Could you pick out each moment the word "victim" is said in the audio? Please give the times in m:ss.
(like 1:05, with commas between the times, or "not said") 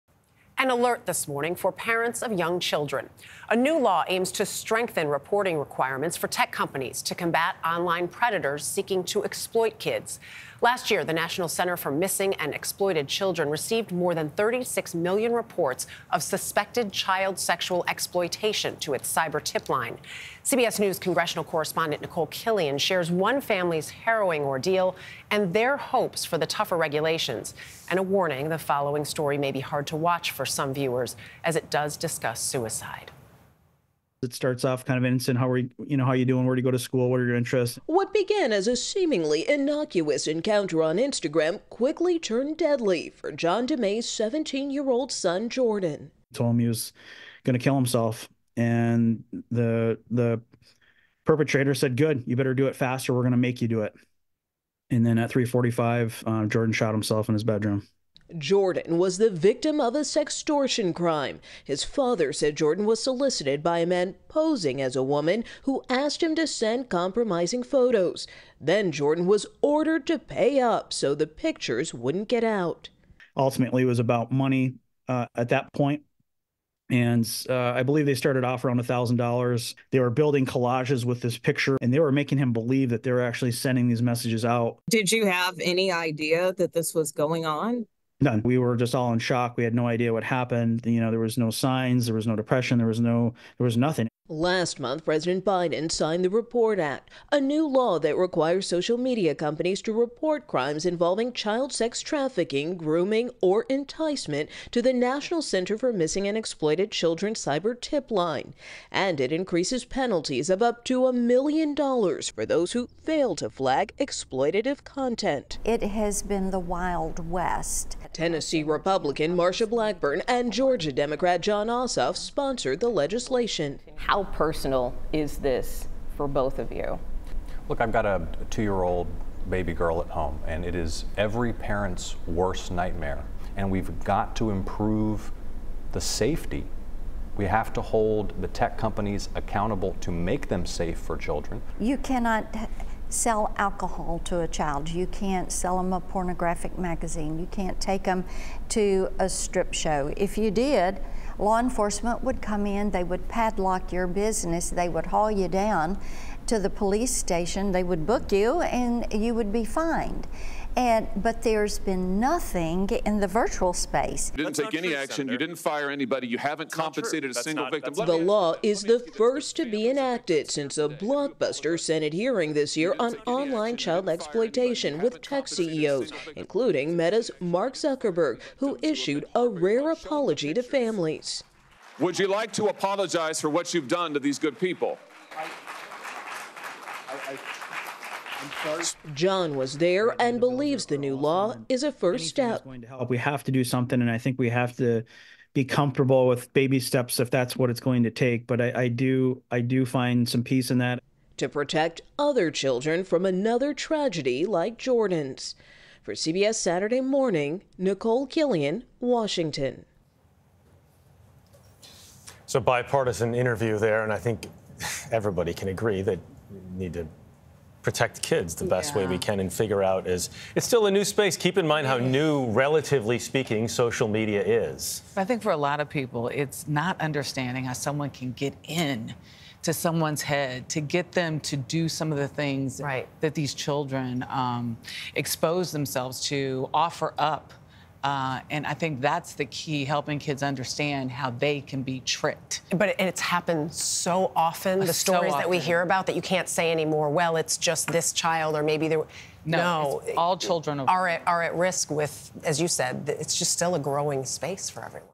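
0:59, 2:47.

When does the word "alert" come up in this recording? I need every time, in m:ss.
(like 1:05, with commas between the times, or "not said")
0:00.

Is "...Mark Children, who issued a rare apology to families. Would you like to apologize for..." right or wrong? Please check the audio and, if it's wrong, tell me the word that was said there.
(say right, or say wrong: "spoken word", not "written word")
wrong: "Zuckerberg", not "Children".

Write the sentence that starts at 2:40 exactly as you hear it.
And but there's been nothing in the virtual space.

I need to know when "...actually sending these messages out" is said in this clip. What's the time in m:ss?
1:23.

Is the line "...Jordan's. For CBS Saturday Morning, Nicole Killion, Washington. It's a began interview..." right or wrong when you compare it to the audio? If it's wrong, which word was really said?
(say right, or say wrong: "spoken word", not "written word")
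wrong: "bipartisan", not "began".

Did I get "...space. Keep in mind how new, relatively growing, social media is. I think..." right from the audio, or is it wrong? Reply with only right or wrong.
wrong.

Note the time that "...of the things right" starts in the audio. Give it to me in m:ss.
3:52.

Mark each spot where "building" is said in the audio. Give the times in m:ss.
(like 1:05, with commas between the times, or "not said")
1:20.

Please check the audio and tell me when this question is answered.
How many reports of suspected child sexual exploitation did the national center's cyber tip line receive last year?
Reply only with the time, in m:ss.
0:13.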